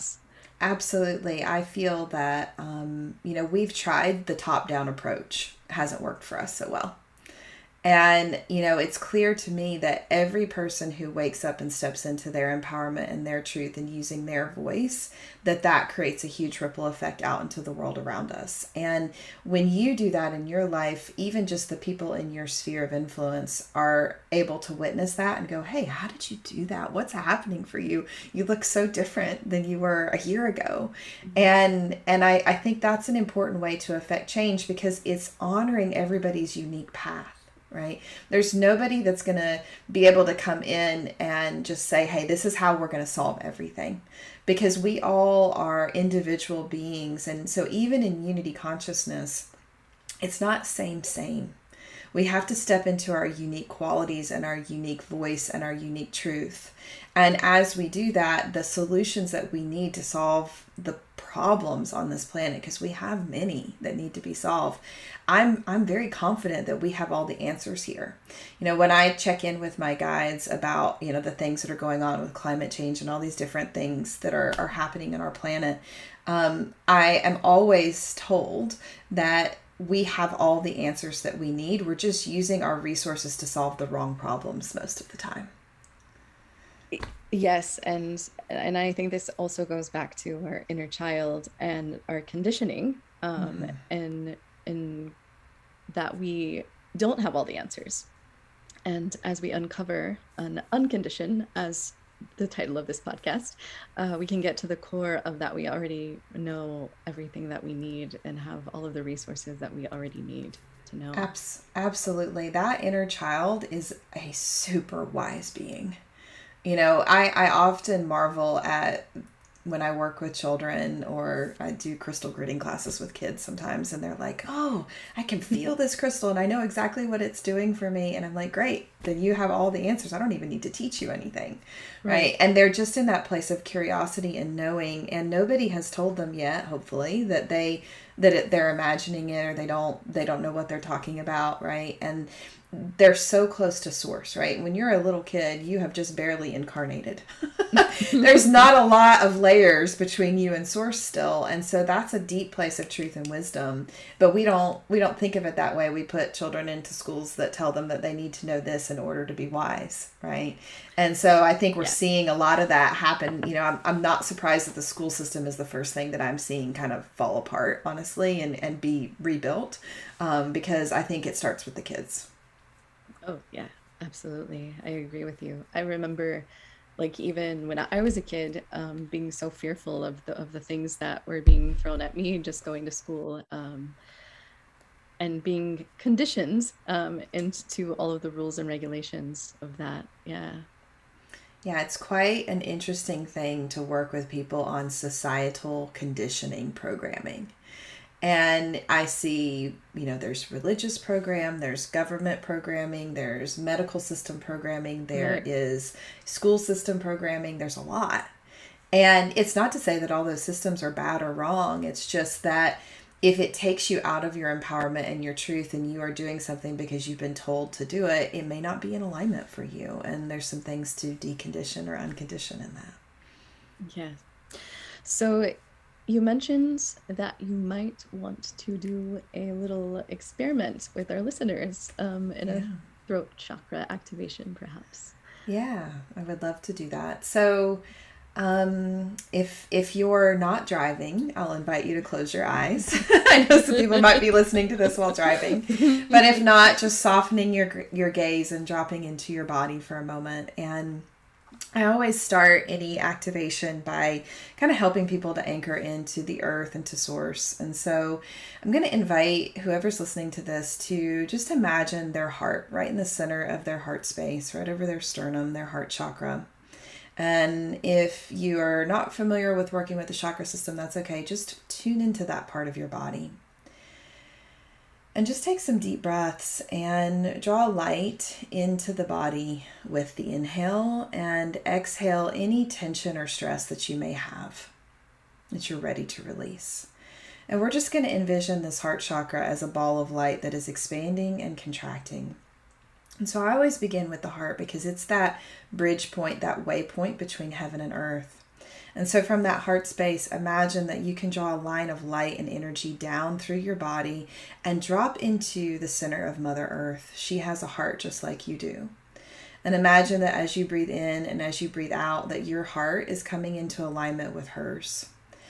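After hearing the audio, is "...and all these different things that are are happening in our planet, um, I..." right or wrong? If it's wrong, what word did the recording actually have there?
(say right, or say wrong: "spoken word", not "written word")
right.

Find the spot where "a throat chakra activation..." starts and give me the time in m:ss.
3:52.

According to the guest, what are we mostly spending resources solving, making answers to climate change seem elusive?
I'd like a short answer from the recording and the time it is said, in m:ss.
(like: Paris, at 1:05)
The wrong problems, at 1:23.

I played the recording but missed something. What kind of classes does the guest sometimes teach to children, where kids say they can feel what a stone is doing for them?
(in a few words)
Crystal gridding.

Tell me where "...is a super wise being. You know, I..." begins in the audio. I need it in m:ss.
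1:53.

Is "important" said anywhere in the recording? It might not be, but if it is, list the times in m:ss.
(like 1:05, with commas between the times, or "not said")
0:33.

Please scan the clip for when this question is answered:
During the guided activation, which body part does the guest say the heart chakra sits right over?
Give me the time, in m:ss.
4:25.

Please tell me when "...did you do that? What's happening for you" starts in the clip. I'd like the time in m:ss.
0:26.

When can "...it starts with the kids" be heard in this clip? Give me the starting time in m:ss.
2:51.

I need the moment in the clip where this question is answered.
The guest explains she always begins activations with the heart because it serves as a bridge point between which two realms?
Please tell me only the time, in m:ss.
4:57.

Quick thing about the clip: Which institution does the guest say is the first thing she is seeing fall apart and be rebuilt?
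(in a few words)
The school system.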